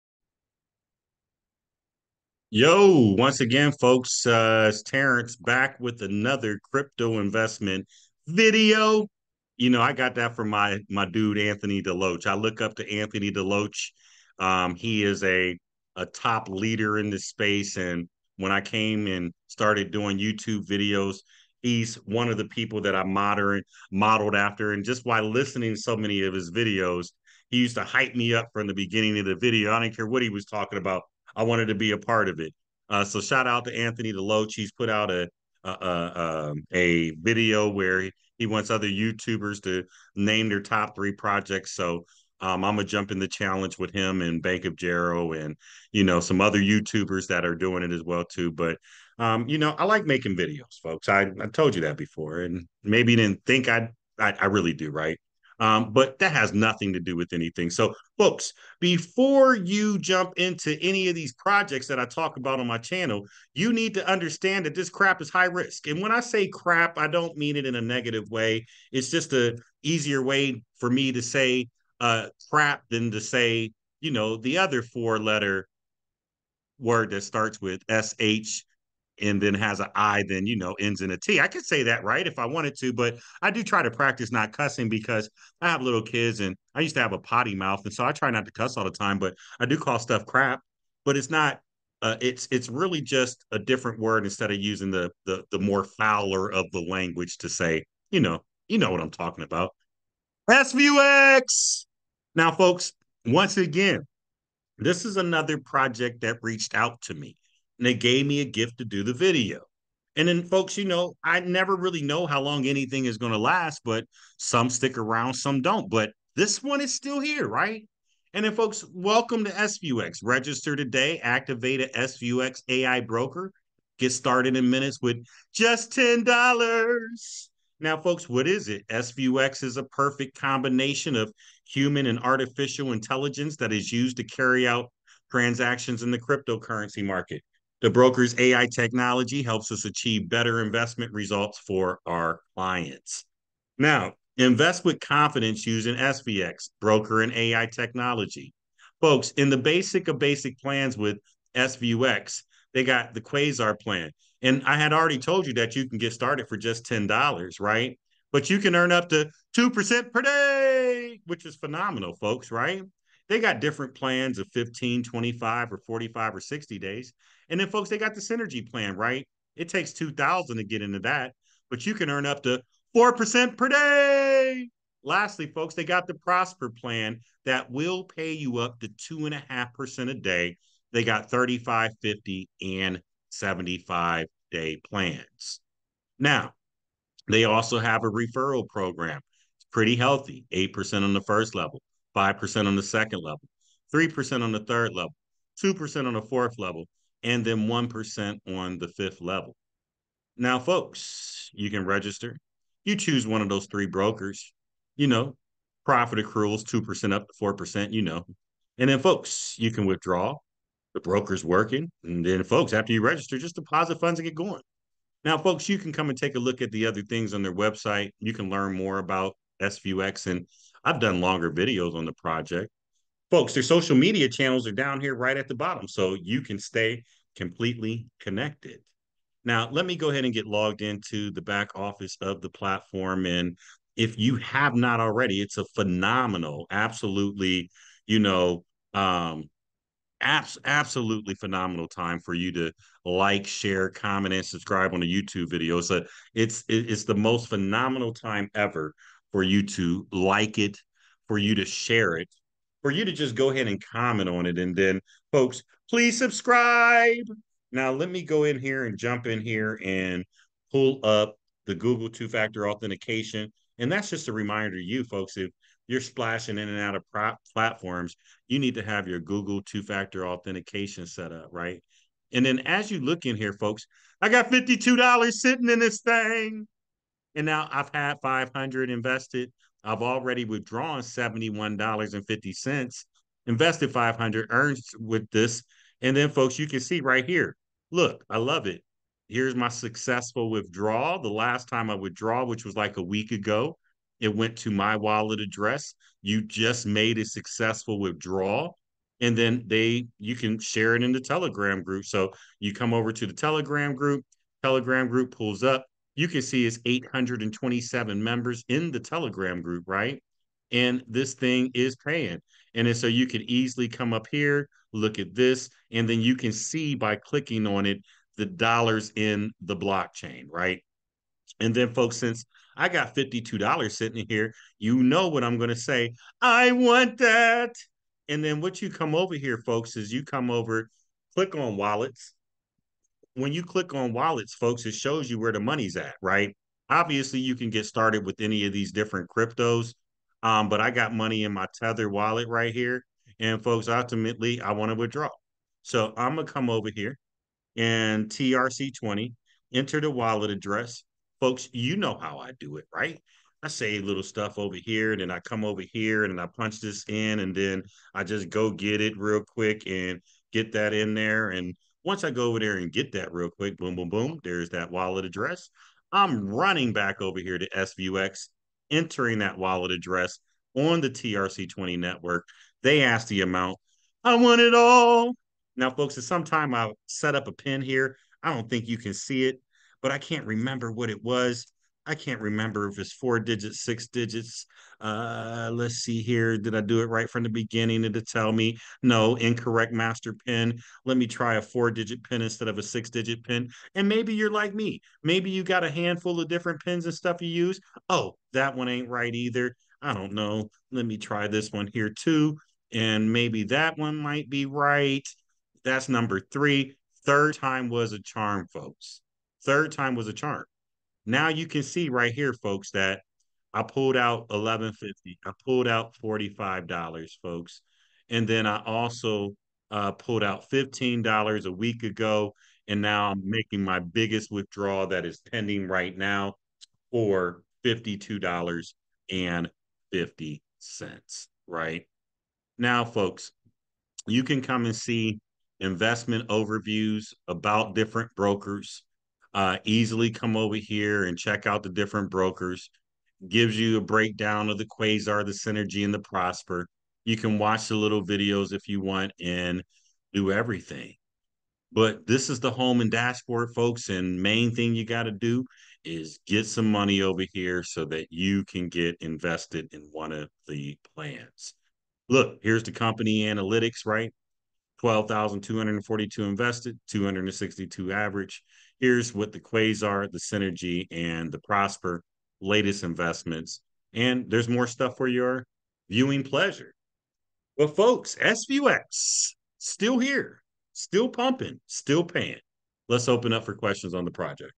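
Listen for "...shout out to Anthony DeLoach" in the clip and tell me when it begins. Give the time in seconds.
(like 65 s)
33 s.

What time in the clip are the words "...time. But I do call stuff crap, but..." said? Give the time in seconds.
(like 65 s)
88 s.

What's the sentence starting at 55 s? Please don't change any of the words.
Um, but that has nothing to do with anything.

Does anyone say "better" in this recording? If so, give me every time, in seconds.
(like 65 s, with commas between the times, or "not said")
140 s.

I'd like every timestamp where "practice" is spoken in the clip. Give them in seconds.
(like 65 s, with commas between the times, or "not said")
83 s.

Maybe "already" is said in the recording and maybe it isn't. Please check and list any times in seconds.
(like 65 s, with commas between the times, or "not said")
154 s, 234 s, 280 s.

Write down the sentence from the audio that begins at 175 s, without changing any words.
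Lastly, folks, they got the Prosper plan that will pay you up to 2.5% a day.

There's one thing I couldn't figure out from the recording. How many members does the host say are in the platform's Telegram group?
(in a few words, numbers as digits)
827.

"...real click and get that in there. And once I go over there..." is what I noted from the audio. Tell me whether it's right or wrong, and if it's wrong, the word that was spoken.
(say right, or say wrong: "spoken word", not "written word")
wrong: "quick", not "click".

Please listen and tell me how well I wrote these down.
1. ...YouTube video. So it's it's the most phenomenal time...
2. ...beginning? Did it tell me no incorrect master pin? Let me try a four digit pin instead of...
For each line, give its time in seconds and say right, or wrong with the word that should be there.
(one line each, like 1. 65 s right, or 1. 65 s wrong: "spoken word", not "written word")
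1. 245 s right
2. 387 s right.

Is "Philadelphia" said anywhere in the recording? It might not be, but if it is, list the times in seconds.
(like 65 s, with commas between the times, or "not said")
not said.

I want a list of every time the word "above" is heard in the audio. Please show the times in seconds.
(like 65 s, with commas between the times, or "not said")
not said.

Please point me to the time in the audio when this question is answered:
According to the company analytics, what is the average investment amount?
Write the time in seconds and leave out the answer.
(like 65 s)
467 s.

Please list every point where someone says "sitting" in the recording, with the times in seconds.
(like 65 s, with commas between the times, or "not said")
275 s, 323 s.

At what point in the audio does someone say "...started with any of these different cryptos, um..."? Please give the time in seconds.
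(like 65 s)
337 s.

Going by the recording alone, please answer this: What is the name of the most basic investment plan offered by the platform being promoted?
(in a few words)
Quasar plan.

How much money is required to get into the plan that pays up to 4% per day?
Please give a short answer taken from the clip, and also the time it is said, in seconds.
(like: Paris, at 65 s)
2000, at 169 s.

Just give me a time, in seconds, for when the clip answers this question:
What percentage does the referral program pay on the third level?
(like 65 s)
193 s.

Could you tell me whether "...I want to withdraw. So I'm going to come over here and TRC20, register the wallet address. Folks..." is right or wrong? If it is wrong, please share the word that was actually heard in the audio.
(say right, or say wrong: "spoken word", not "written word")
wrong: "enter", not "register".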